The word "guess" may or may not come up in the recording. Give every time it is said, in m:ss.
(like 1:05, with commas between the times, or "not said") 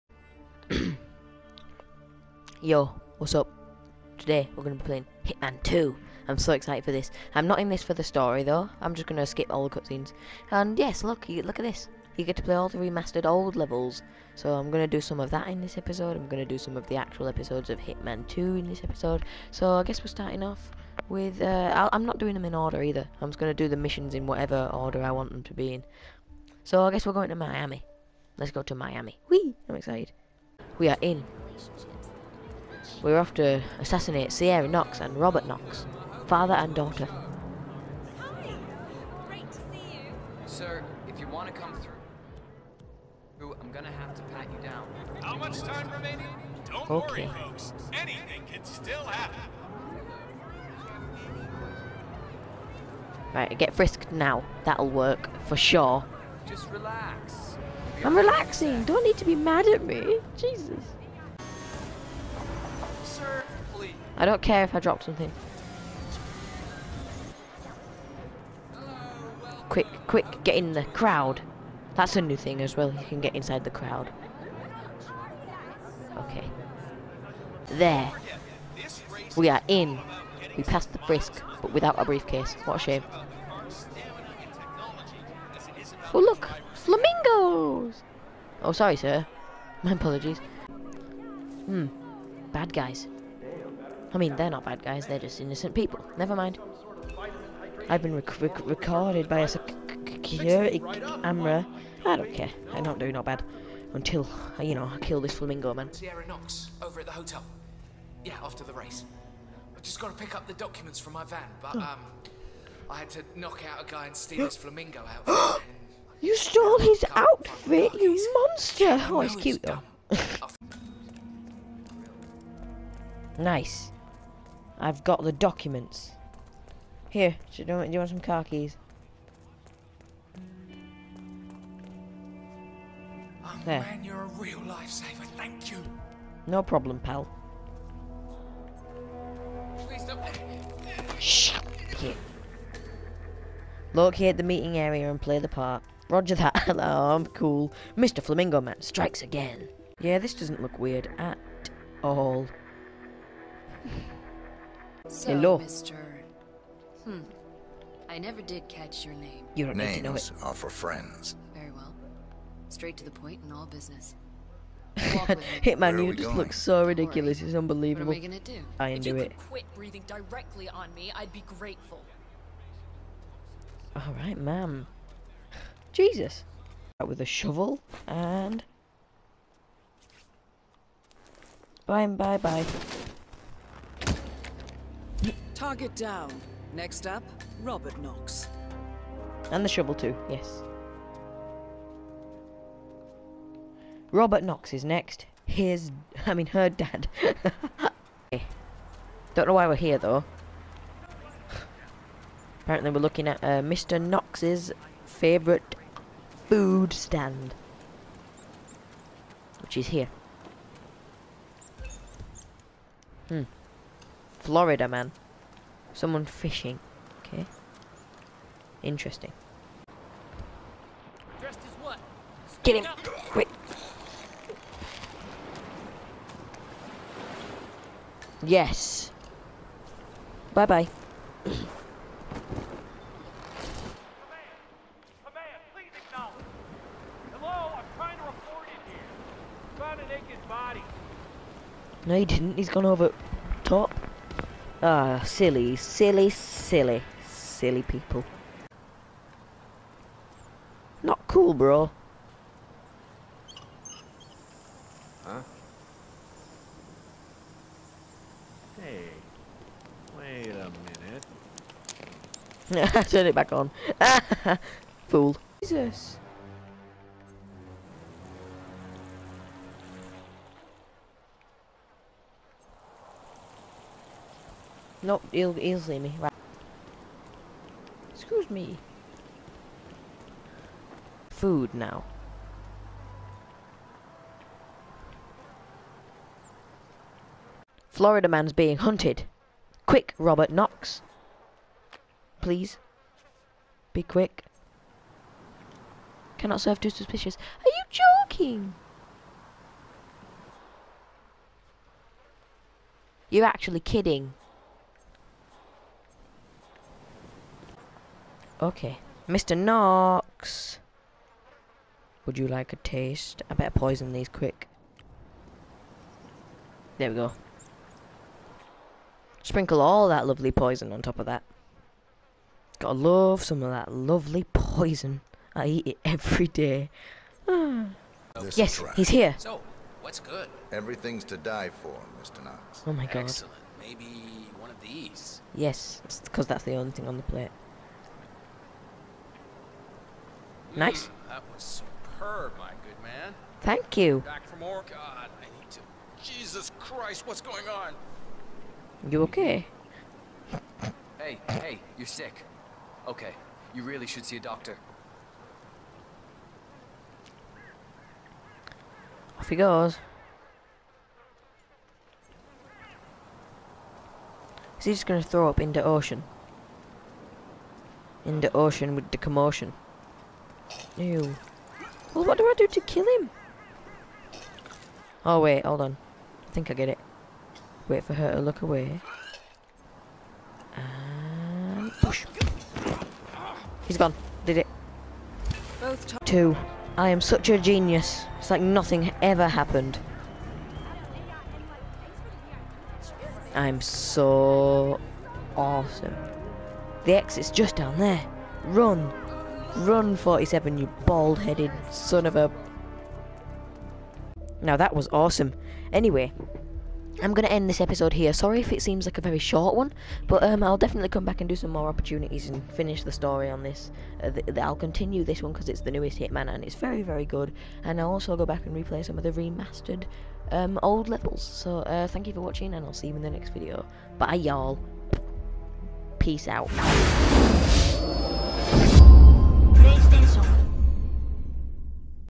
0:19, 0:26.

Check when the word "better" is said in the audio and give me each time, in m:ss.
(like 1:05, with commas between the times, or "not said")
5:13.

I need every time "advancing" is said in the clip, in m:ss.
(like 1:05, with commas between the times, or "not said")
not said.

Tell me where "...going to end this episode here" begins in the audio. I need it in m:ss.
6:47.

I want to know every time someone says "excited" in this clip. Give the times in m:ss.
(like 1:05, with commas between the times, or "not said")
0:06, 0:29.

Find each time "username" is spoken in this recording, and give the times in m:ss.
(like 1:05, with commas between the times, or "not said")
not said.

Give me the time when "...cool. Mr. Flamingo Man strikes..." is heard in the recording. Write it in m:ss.
2:27.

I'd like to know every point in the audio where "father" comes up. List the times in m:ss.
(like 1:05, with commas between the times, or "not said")
0:36.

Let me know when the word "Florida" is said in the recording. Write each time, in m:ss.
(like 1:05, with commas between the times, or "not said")
3:34, 4:47.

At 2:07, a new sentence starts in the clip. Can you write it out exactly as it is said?
Here, do you, want, some car keys?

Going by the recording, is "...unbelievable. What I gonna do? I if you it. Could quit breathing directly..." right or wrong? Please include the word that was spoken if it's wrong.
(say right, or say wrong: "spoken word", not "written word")
right.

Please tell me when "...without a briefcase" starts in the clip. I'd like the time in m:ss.
1:21.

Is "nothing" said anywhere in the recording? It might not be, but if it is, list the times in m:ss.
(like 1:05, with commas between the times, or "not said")
6:28.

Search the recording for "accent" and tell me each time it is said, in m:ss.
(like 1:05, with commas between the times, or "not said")
not said.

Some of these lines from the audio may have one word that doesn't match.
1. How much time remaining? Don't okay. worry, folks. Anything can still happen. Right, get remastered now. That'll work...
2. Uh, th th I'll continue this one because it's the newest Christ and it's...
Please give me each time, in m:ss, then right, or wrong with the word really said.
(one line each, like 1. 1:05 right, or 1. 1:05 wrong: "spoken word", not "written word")
1. 0:45 wrong: "frisked", not "remastered"
2. 6:54 wrong: "Hitman", not "Christ".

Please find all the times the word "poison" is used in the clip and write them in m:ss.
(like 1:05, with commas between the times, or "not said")
5:13, 5:20, 5:24.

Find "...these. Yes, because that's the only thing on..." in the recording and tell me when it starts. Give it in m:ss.
5:34.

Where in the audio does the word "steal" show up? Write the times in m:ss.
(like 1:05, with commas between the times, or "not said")
1:54.